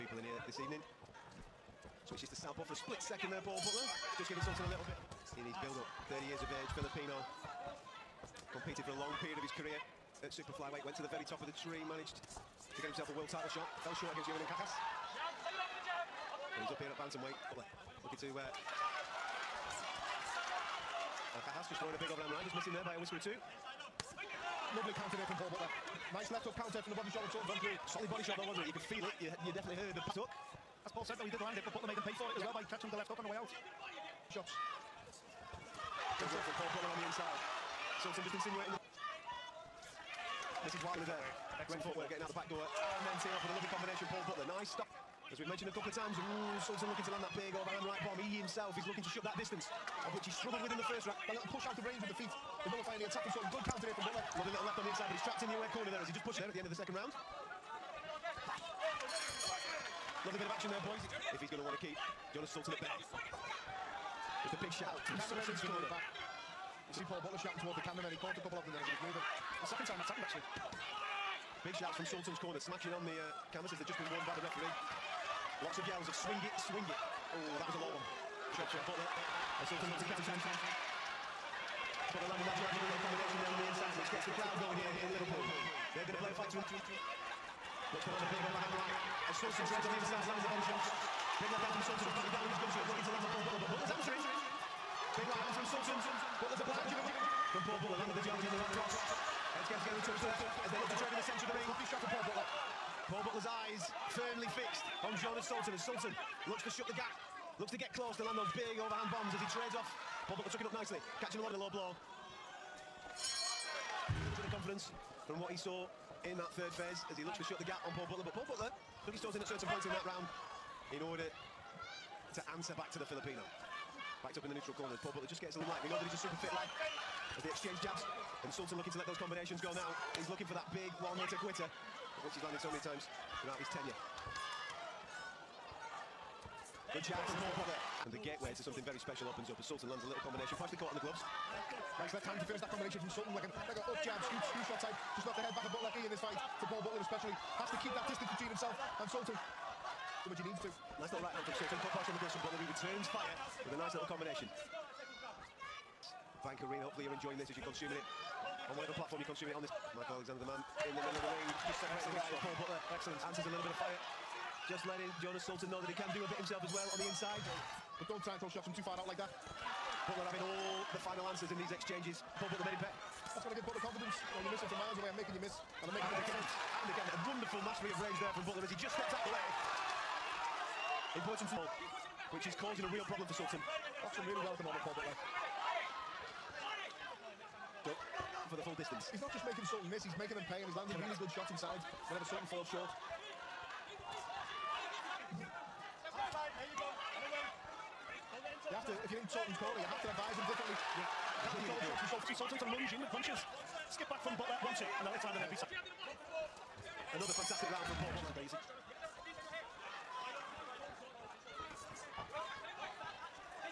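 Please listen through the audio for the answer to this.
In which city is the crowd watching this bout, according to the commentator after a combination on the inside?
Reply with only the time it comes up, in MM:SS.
01:25.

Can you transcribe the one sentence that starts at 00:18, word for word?
Uh, Kakas just throwing a big overhand right, just missing there by a whisker or two.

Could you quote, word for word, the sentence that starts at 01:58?
But Paul Butler dug his toes in at certain points in that round in order to answer back to the Filipino.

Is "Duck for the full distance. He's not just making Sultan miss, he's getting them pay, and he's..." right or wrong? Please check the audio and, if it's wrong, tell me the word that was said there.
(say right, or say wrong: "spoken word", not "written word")
wrong: "making", not "getting".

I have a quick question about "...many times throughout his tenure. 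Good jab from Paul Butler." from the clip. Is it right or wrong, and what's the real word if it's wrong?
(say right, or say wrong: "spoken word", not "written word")
right.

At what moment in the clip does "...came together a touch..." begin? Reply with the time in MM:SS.
01:39.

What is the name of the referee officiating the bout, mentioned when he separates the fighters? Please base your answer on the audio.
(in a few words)
Michael Alexander.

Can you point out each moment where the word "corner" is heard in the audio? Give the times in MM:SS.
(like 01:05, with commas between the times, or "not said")
00:55, 01:05, 01:12, 02:04, 03:19.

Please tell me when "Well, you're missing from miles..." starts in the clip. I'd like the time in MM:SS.
02:54.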